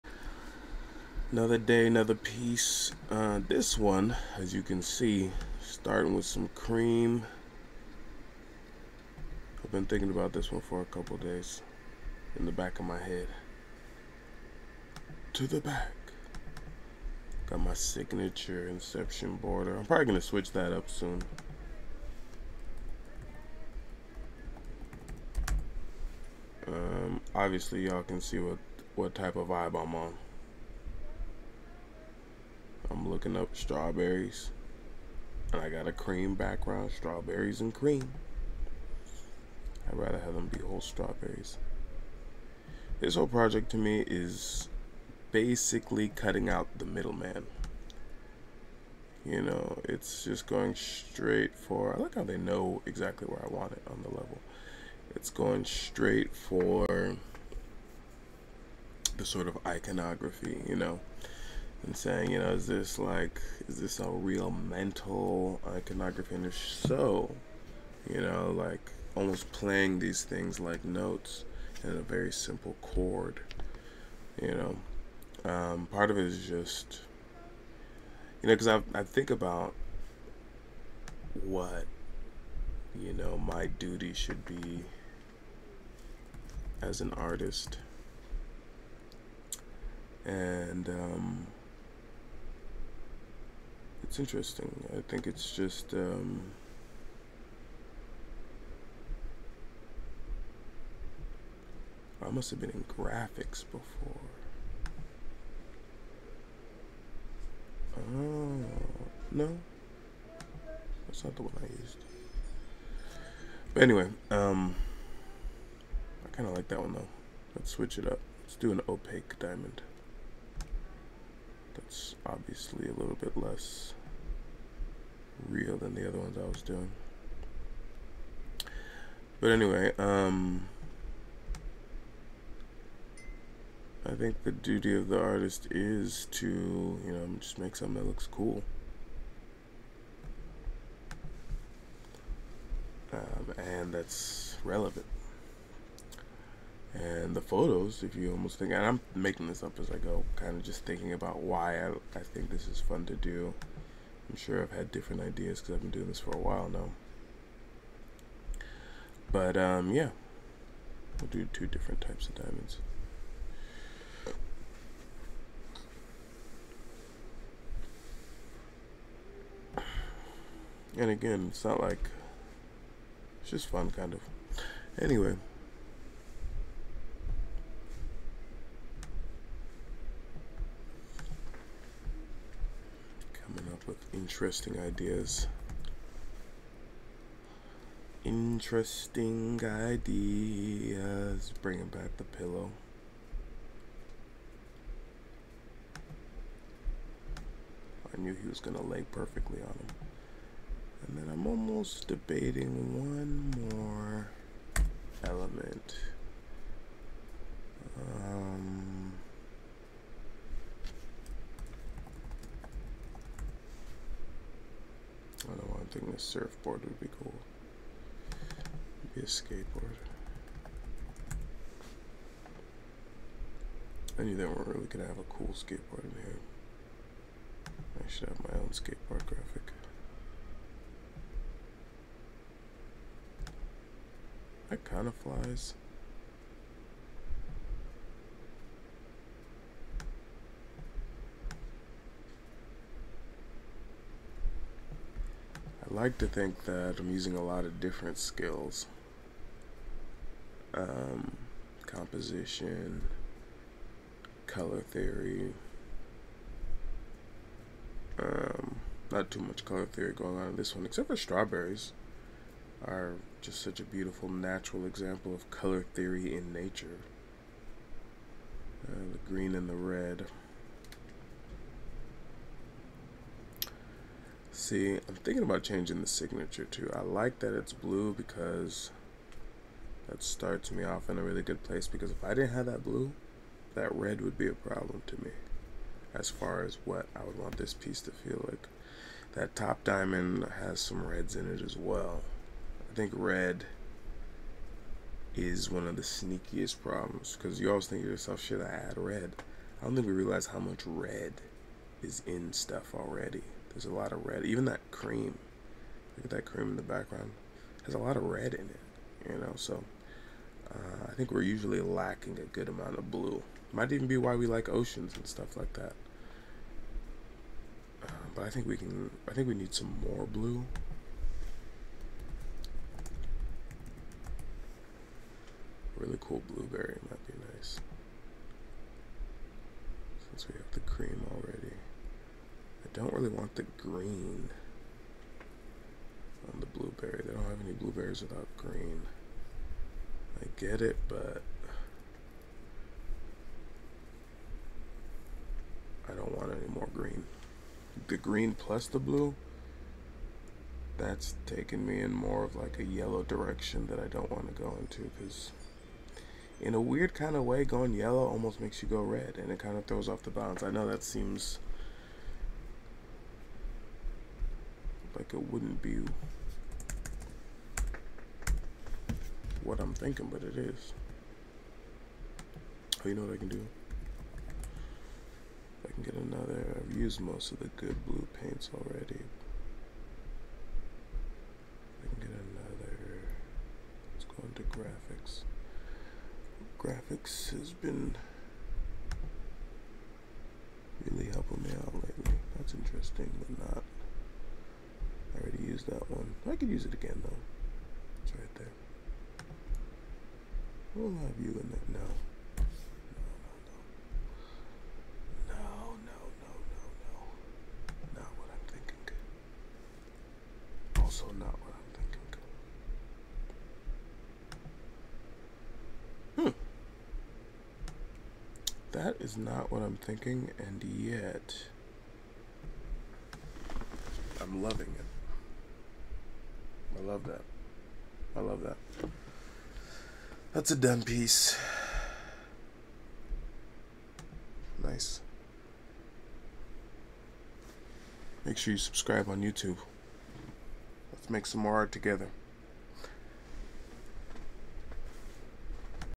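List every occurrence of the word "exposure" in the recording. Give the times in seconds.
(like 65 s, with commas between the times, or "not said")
not said.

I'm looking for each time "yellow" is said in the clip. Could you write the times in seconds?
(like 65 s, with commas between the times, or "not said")
352 s, 357 s.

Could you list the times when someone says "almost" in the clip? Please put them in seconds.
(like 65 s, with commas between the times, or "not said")
69 s, 148 s, 201 s, 358 s.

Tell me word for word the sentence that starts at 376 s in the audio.
I've used most of the good blue paints already.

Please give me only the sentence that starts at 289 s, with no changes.
That top diamond has some reds in it as well.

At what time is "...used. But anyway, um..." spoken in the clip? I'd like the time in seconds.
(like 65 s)
111 s.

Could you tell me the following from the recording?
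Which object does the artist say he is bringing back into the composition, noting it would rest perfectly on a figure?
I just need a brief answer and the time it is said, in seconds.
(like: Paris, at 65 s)
The pillow, at 192 s.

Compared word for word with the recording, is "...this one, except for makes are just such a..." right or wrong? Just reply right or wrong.
wrong.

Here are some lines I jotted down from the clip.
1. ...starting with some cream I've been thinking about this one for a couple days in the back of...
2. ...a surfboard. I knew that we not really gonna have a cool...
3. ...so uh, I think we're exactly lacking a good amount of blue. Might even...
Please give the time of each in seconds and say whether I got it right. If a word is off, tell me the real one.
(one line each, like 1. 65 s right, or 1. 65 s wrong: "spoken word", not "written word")
1. 5 s right
2. 219 s wrong: "skateboard", not "surfboard"
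3. 309 s wrong: "usually", not "exactly".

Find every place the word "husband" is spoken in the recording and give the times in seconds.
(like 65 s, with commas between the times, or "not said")
not said.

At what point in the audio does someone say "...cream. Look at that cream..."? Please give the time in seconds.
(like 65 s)
304 s.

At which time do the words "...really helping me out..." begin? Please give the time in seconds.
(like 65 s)
391 s.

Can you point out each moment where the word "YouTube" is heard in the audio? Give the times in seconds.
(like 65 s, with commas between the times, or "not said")
439 s.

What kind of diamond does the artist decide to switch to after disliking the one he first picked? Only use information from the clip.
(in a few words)
Opaque diamond.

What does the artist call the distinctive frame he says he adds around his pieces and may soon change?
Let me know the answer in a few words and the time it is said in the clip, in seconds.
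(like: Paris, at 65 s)
Inception border, at 18 s.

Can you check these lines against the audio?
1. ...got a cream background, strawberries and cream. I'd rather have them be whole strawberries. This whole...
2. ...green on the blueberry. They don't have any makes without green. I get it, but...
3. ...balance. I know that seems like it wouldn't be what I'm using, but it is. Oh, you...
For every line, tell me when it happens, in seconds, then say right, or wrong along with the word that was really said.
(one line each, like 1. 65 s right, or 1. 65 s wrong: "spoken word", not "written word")
1. 35 s right
2. 333 s wrong: "blueberries", not "makes"
3. 360 s wrong: "thinking", not "using".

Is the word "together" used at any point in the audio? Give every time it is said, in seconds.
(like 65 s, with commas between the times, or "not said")
441 s.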